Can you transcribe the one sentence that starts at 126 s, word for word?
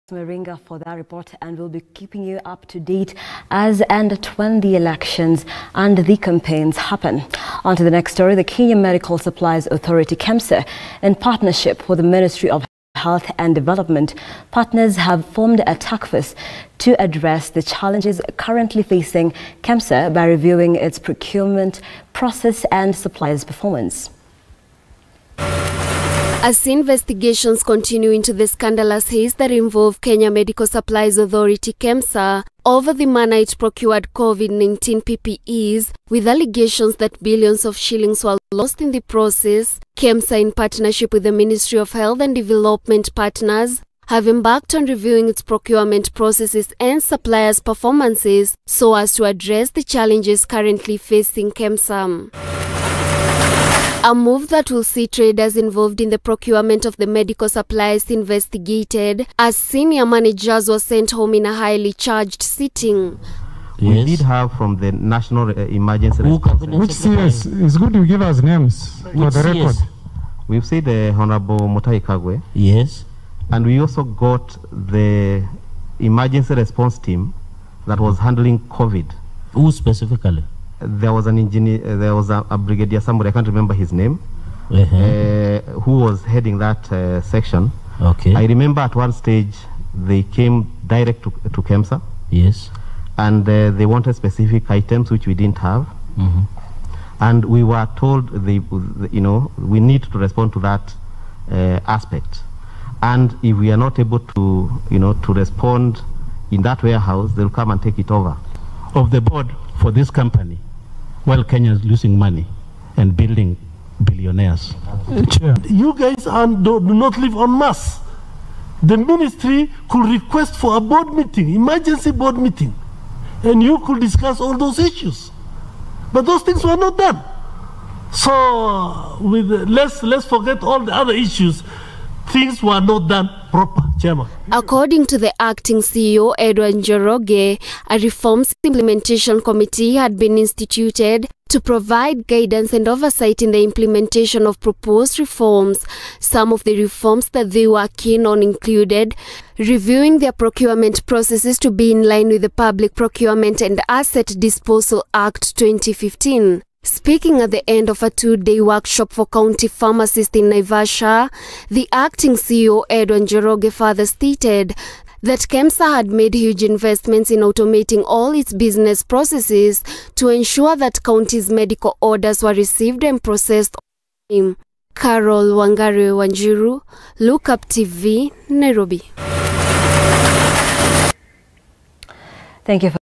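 But those things were not done.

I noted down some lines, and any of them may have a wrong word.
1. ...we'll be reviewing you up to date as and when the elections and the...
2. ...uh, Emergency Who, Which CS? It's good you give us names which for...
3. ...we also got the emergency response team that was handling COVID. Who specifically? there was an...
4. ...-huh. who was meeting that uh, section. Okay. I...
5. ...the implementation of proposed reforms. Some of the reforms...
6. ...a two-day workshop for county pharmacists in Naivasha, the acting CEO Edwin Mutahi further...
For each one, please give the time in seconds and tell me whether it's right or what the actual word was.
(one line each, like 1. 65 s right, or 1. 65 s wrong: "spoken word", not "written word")
1. 1 s wrong: "keeping", not "reviewing"
2. 65 s right
3. 73 s right
4. 84 s wrong: "heading", not "meeting"
5. 143 s right
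6. 158 s wrong: "Njoroge", not "Mutahi".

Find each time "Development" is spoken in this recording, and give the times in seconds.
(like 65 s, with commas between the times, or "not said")
13 s, 42 s.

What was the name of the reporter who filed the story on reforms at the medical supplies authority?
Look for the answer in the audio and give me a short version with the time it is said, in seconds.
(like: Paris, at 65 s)
Carol Wangari Wanjiru, at 174 s.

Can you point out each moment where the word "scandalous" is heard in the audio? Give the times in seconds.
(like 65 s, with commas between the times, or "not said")
28 s.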